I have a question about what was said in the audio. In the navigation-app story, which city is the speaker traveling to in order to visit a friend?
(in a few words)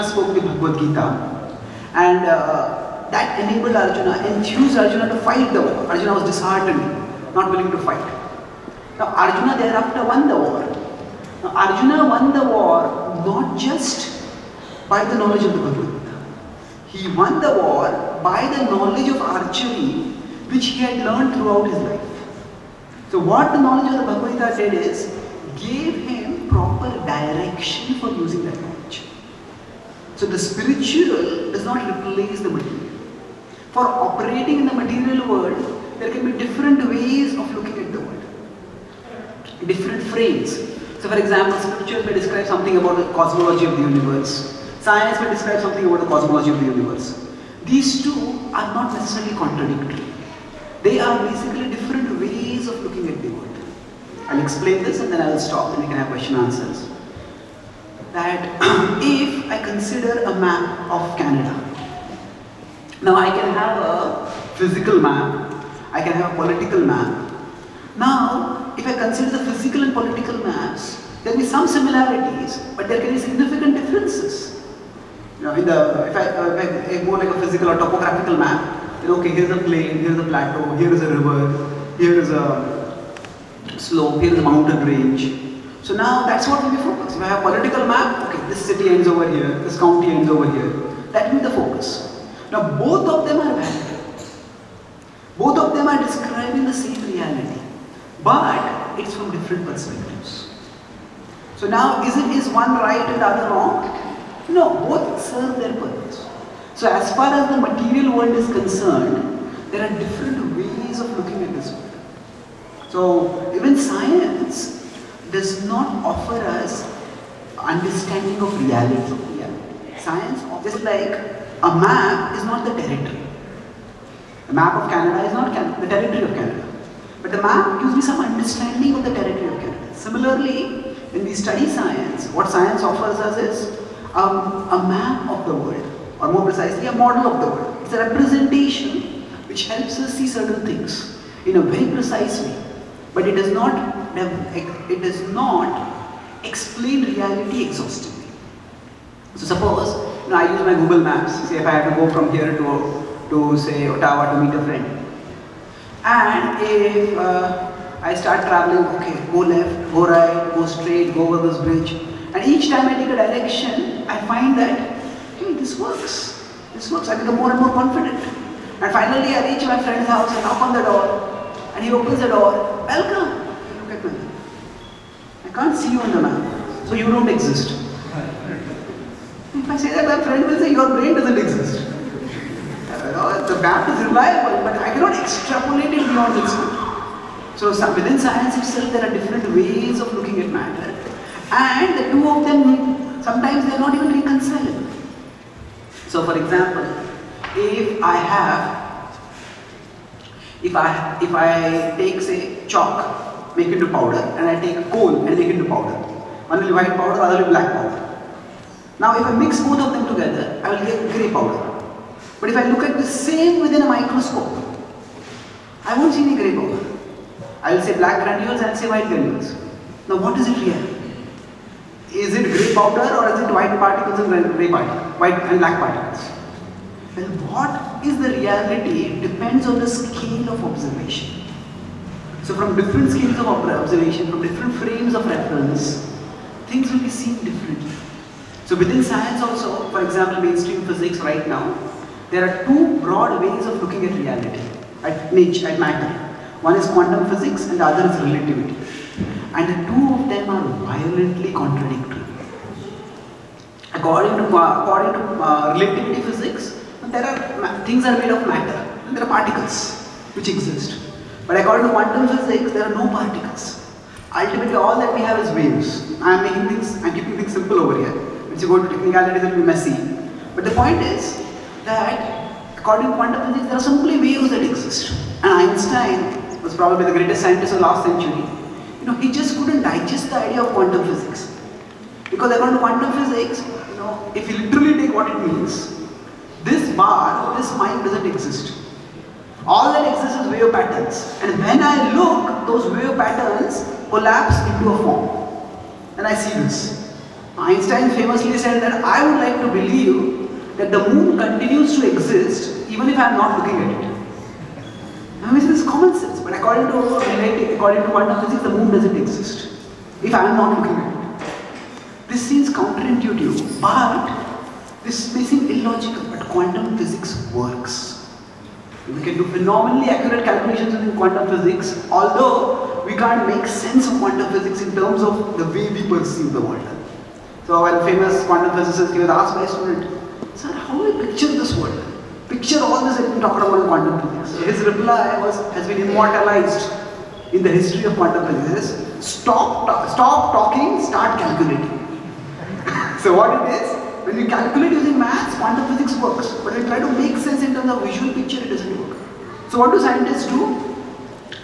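Ottawa.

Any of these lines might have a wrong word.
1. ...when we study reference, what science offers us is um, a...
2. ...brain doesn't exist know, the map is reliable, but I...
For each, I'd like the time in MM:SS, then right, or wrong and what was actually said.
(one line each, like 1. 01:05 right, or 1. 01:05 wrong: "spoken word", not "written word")
1. 02:11 wrong: "science", not "reference"
2. 03:00 right.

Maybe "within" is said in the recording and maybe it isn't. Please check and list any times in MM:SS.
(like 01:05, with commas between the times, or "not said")
03:07, 03:33, 03:58.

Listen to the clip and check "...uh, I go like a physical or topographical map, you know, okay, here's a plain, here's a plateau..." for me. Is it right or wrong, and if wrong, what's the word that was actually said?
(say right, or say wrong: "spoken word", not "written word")
right.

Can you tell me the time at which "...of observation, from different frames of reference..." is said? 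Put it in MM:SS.
03:53.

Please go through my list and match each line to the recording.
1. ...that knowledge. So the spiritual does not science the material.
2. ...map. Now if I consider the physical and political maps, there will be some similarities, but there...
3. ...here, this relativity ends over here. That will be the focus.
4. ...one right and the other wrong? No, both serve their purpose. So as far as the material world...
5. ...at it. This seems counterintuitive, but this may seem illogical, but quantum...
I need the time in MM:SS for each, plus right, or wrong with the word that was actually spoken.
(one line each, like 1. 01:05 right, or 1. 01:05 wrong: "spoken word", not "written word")
1. 00:28 wrong: "replace", not "science"
2. 01:06 right
3. 01:29 wrong: "county", not "relativity"
4. 01:42 right
5. 05:10 right.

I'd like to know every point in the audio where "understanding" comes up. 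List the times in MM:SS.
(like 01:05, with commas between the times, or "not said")
01:57, 02:08.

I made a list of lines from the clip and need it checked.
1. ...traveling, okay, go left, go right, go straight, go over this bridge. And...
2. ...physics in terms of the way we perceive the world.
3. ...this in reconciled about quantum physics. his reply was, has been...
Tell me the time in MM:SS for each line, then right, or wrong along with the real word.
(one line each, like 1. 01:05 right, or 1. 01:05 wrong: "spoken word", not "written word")
1. 02:38 right
2. 05:24 right
3. 05:33 wrong: "talked", not "reconciled".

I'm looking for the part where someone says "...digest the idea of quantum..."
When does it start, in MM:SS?
04:39.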